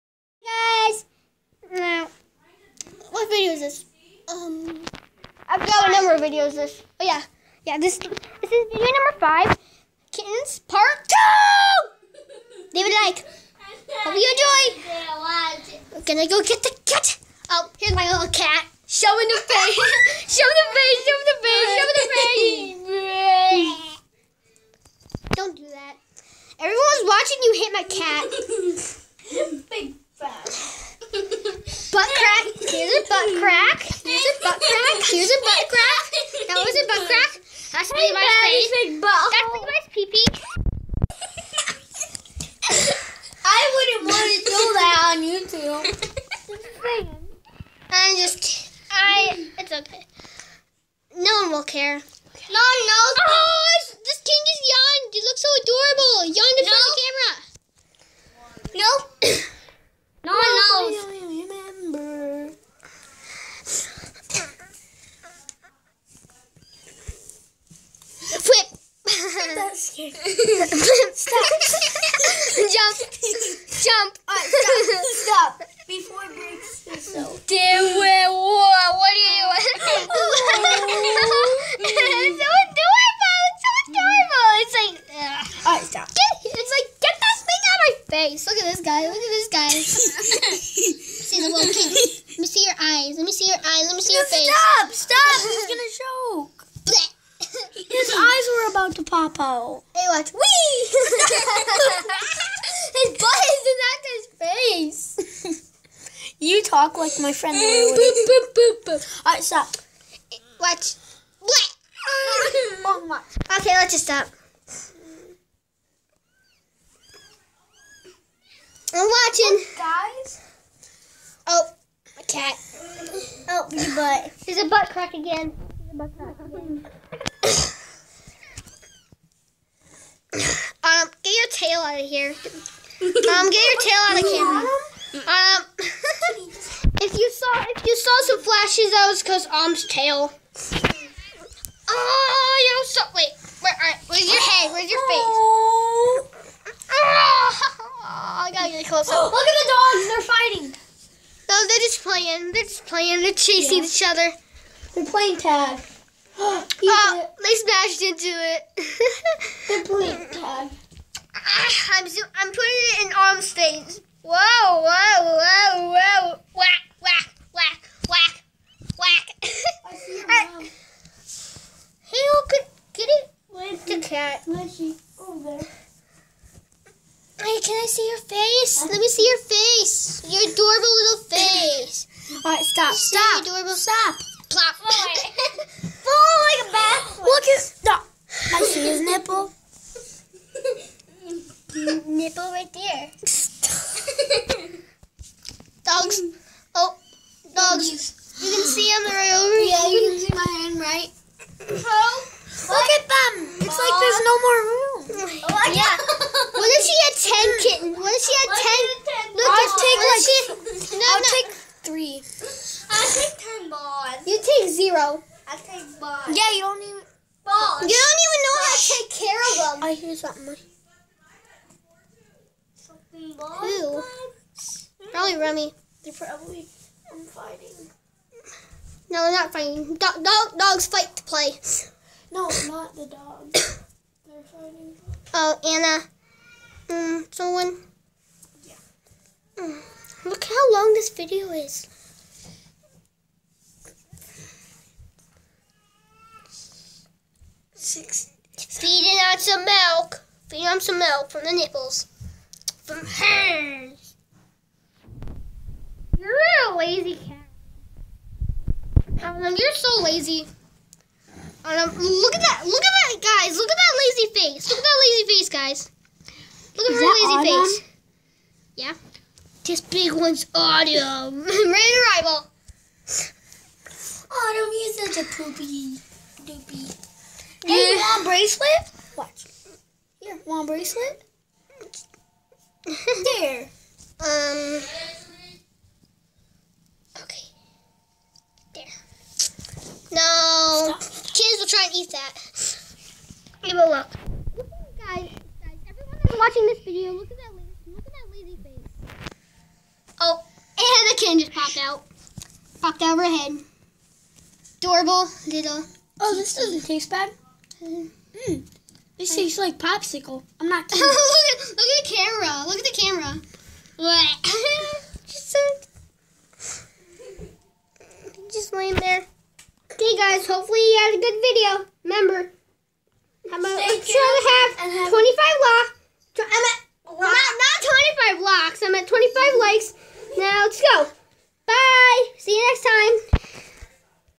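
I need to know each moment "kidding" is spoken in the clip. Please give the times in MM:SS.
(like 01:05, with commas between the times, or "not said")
00:48, 05:10.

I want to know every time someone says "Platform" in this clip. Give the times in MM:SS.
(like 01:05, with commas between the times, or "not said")
03:04.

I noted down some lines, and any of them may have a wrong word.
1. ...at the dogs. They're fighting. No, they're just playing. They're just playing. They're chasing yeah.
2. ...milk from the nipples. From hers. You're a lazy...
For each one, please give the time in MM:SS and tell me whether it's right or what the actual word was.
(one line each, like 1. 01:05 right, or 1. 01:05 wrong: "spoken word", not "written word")
1. 02:29 right
2. 04:10 right.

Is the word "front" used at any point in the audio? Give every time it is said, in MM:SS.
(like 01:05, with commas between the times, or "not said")
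00:58.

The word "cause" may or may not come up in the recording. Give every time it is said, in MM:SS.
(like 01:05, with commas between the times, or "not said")
02:19.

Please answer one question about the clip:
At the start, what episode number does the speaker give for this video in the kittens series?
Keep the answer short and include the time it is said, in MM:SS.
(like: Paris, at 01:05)
5, at 00:09.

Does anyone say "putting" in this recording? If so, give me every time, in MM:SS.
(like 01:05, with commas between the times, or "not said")
02:42.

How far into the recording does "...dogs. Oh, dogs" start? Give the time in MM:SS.
03:15.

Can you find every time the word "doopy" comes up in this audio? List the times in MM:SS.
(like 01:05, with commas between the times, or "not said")
04:36.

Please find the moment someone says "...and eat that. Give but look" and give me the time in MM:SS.
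04:51.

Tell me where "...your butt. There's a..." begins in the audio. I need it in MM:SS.
02:03.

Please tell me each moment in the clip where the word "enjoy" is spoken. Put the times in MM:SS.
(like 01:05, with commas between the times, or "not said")
00:14.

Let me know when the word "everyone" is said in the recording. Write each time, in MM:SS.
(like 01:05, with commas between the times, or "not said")
00:26, 04:55.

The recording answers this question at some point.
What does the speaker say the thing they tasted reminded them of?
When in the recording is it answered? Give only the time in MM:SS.
05:09.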